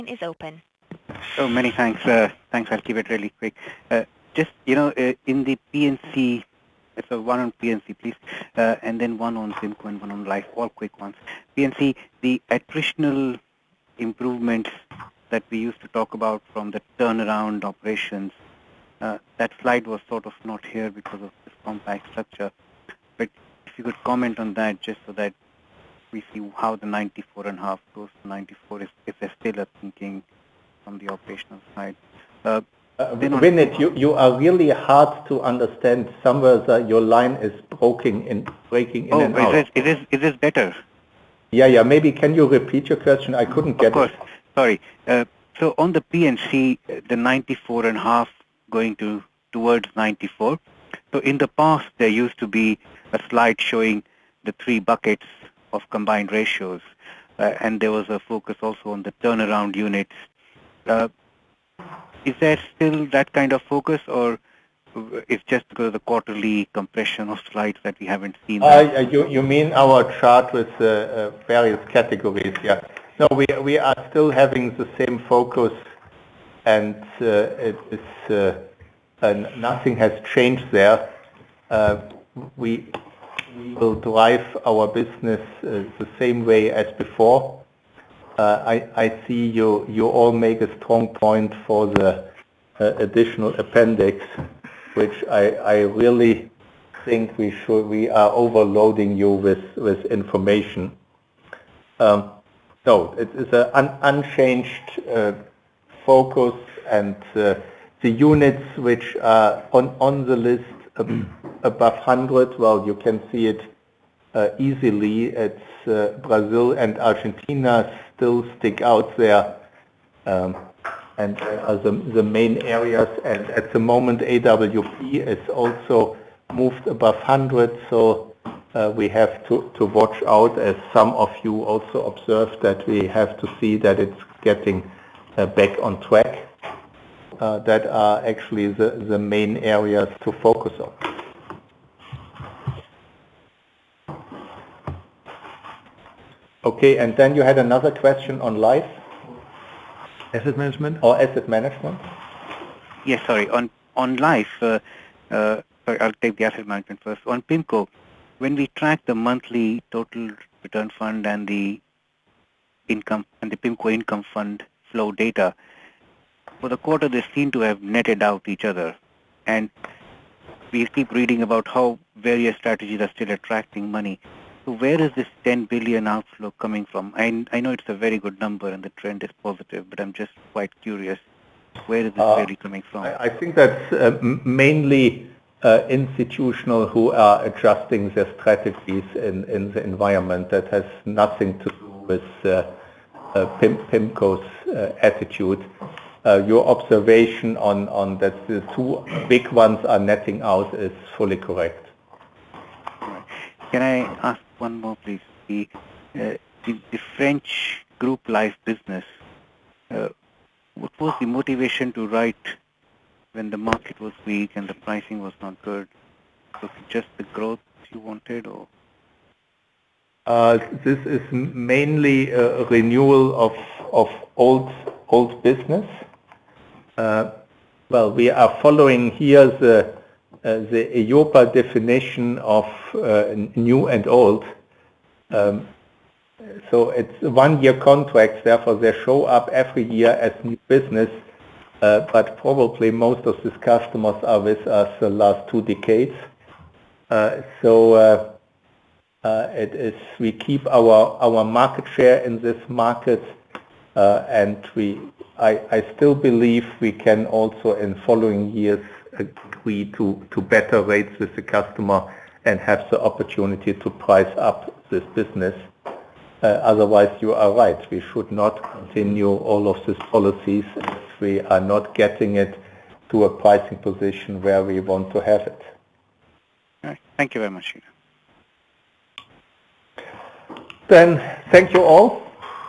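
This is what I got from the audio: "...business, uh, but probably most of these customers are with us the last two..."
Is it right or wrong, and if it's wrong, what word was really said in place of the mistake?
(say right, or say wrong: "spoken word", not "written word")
right.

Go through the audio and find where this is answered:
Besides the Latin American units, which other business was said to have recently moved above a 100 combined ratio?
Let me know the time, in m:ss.
2:04.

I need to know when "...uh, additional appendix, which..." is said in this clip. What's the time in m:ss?
1:32.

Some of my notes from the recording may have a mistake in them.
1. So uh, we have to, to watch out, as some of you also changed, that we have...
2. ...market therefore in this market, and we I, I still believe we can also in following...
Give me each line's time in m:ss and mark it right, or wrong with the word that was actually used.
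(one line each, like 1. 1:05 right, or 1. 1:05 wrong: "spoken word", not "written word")
1. 2:07 wrong: "observed", not "changed"
2. 4:11 wrong: "share", not "therefore".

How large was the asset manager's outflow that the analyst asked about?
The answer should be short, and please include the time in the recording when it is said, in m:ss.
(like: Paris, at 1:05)
10 billion, at 2:55.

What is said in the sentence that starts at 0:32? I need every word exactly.
Uh, uh, Vinit, you, you are really hard to understand.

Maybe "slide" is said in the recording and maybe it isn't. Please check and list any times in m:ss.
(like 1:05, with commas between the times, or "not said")
0:19, 0:53, 1:07.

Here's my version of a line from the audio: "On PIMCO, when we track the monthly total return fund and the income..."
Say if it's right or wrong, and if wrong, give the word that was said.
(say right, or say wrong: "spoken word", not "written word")
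right.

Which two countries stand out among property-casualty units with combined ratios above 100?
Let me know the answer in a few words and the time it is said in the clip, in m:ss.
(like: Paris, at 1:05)
Brazil and Argentina, at 1:56.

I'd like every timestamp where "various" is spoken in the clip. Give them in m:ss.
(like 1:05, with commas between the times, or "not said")
1:11, 2:52.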